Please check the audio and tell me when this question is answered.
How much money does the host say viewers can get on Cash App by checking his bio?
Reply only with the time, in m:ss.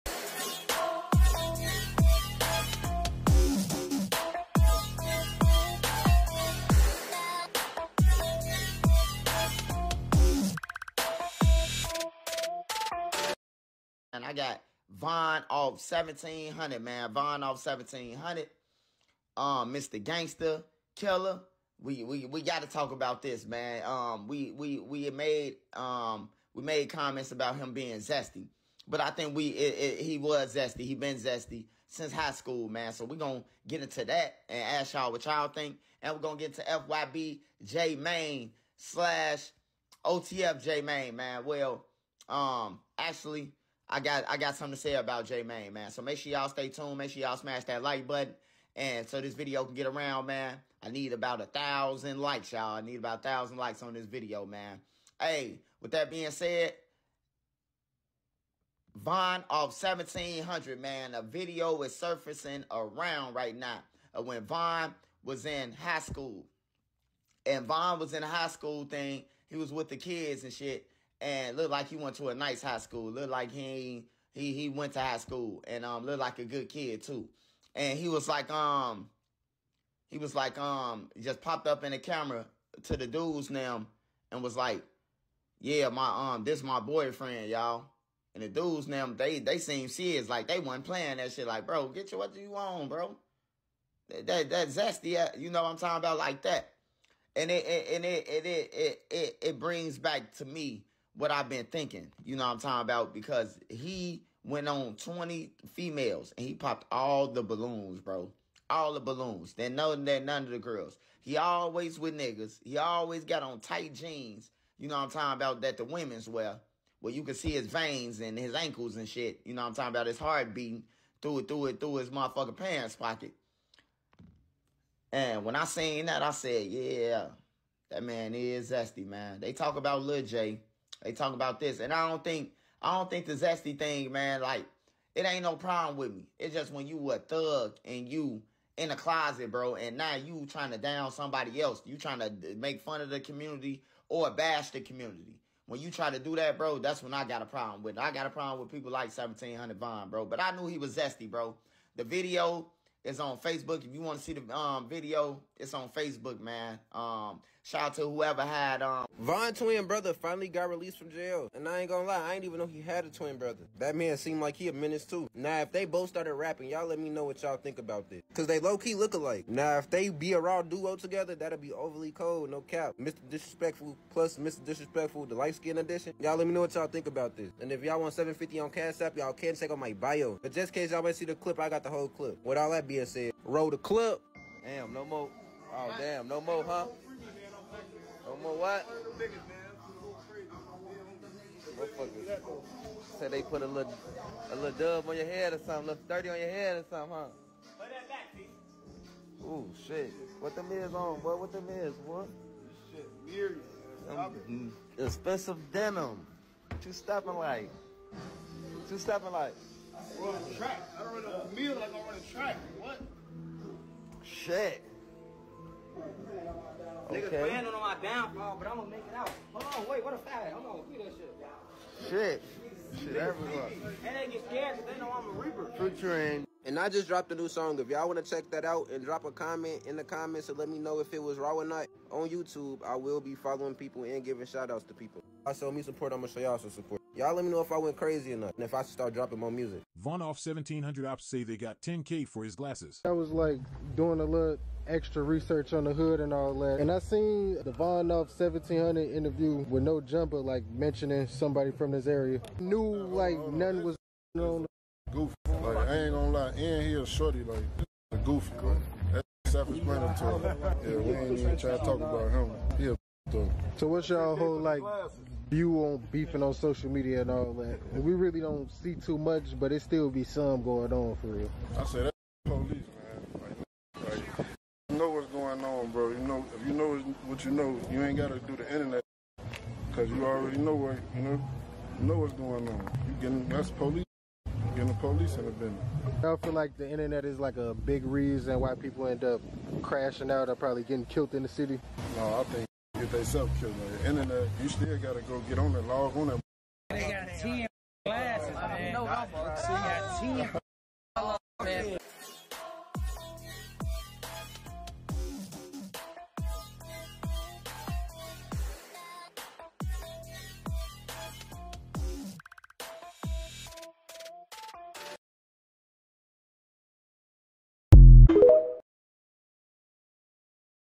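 2:58.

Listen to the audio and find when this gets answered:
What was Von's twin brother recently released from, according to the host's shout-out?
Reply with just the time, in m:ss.
2:41.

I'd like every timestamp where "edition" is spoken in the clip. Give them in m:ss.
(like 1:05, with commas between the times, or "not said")
2:55.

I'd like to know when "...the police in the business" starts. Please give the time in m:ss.
4:44.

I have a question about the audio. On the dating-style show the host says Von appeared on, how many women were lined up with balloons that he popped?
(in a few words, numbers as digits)
20.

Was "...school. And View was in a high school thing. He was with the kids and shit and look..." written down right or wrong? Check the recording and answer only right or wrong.
wrong.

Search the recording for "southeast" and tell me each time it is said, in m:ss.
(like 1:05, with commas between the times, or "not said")
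not said.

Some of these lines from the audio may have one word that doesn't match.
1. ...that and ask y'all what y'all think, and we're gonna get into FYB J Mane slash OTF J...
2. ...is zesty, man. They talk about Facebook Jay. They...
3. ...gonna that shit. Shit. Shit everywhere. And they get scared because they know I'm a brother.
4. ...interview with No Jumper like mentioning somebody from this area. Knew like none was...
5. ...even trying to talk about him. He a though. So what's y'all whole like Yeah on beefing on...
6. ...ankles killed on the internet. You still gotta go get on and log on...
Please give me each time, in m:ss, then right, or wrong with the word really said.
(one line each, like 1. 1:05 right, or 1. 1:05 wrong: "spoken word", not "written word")
1. 0:34 right
2. 2:08 wrong: "Lil", not "Facebook"
3. 3:40 wrong: "reaper", not "brother"
4. 4:09 right
5. 4:21 wrong: "View", not "Yeah"
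6. 4:53 wrong: "themselves", not "ankles".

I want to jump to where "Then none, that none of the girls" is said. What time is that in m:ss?
1:49.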